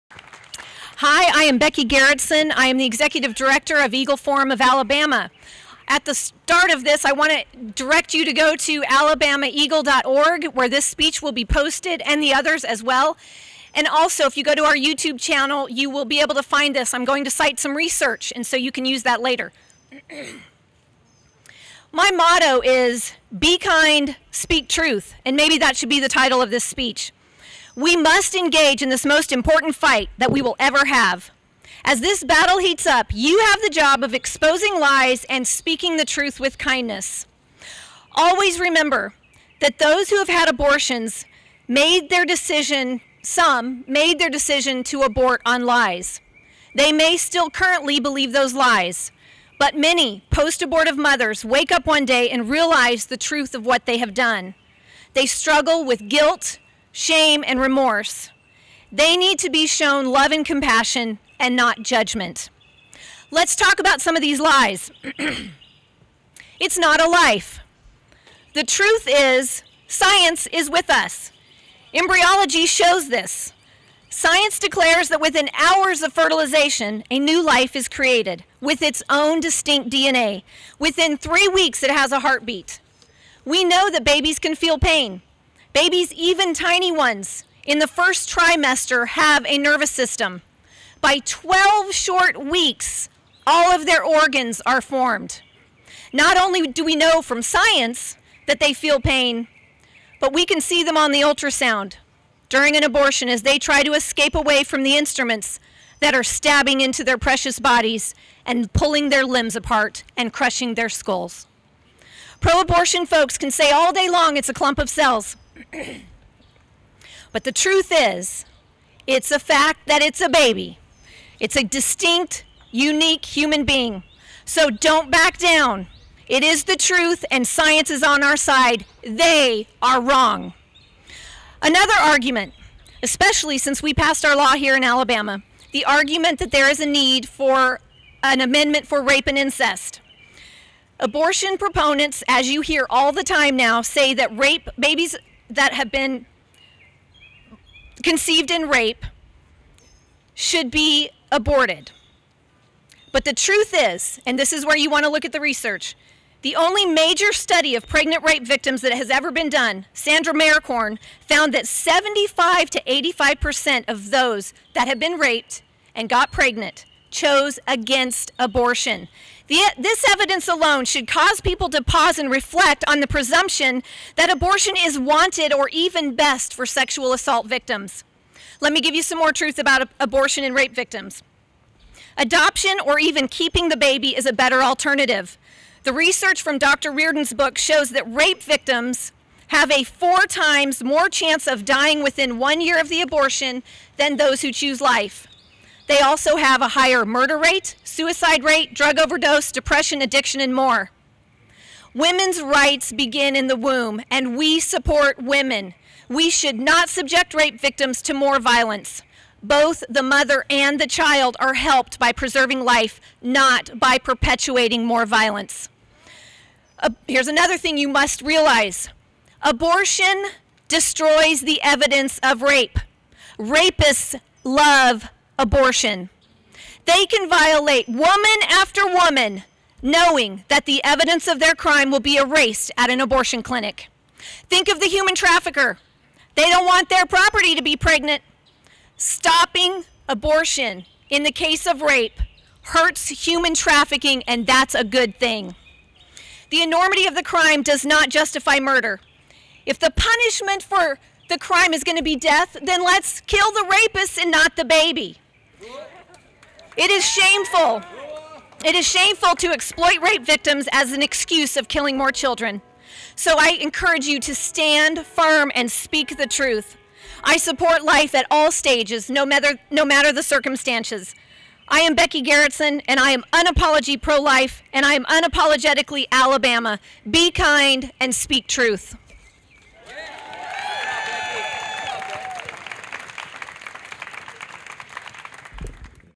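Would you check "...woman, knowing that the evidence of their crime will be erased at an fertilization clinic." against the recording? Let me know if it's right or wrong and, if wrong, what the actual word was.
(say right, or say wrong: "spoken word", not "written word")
wrong: "abortion", not "fertilization".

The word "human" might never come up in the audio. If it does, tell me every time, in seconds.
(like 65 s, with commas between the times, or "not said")
123 s, 234 s, 243 s.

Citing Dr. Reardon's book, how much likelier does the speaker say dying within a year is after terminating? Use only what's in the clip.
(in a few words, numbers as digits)
4 times.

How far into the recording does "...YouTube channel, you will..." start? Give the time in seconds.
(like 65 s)
14 s.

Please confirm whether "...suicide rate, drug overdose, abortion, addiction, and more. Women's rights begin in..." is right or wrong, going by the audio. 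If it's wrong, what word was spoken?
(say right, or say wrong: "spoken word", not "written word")
wrong: "depression", not "abortion".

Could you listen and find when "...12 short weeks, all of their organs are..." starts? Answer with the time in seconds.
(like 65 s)
91 s.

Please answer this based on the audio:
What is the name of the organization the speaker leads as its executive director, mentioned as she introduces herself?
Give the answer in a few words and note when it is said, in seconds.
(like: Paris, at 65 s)
Eagle Forum of Alabama, at 3 s.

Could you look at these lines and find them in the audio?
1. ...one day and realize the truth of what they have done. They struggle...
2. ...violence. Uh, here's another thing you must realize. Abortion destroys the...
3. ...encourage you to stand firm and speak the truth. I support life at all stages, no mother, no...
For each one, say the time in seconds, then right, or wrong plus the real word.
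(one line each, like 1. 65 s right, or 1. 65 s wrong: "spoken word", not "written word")
1. 51 s right
2. 215 s right
3. 263 s wrong: "matter", not "mother".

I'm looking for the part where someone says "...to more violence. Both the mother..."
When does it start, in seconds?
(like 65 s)
208 s.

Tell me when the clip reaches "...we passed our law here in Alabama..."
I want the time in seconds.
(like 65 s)
133 s.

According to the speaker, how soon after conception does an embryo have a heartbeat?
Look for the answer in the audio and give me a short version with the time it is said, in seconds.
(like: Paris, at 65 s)
3 weeks, at 81 s.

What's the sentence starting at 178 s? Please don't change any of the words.
Let me give you some more truth about abortion and rape victims.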